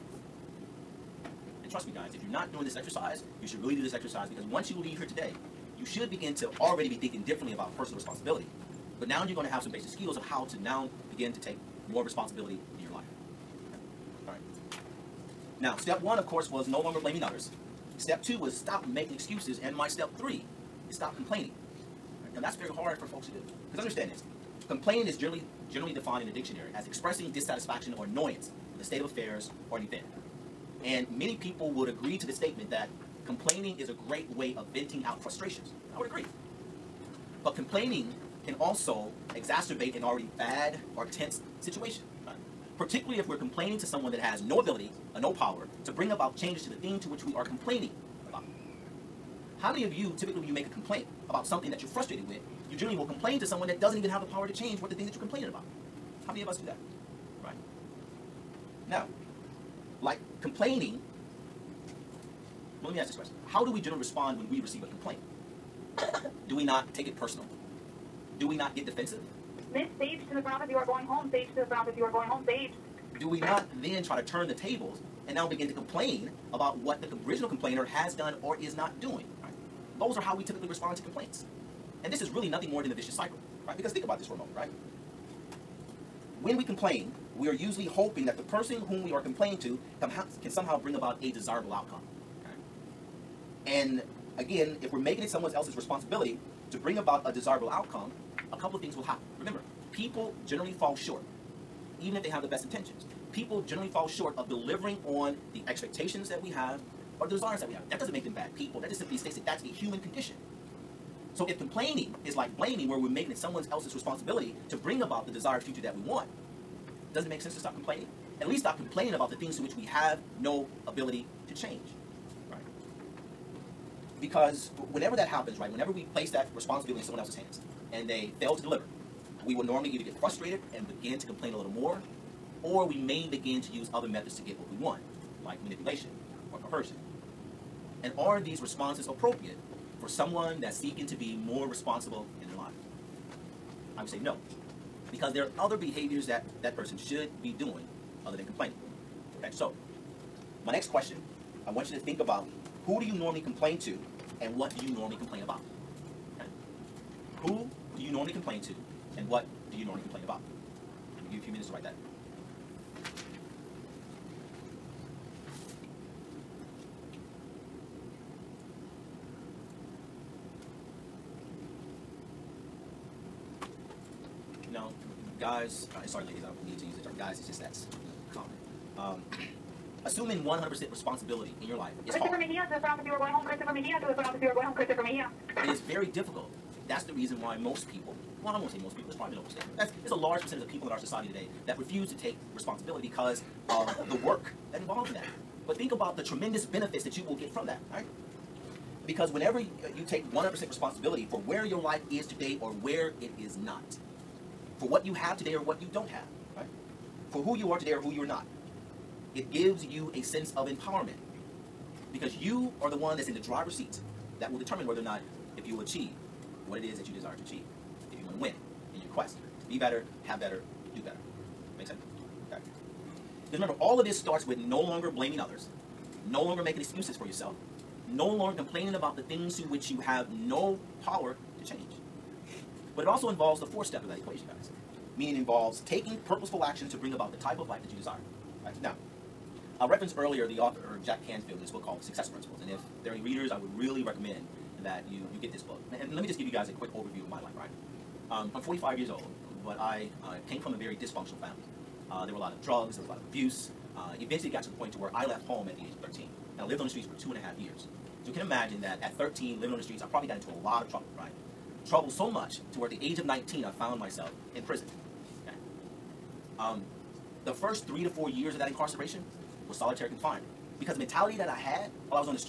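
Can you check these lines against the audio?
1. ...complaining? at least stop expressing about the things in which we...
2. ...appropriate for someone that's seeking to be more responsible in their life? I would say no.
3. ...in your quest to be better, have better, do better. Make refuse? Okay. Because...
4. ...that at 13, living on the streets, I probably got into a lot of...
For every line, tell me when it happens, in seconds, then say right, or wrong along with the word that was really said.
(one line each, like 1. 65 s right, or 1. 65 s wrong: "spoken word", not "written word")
1. 117 s wrong: "complaining", not "expressing"
2. 139 s right
3. 218 s wrong: "sense", not "refuse"
4. 258 s right.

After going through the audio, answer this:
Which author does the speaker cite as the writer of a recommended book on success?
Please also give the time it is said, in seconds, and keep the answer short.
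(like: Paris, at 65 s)
Jack Canfield, at 241 s.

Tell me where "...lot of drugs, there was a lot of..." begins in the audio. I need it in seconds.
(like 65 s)
252 s.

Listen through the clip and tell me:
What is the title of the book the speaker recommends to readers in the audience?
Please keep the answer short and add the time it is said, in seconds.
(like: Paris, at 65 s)
The Success Principles, at 241 s.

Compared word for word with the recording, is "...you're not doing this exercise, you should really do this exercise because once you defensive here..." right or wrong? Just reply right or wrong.
wrong.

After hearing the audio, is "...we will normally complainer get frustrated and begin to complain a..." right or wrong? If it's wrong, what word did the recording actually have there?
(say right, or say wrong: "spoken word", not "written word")
wrong: "either", not "complainer".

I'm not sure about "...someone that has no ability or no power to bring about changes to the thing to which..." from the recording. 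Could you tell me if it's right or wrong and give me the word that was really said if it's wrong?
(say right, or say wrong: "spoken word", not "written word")
right.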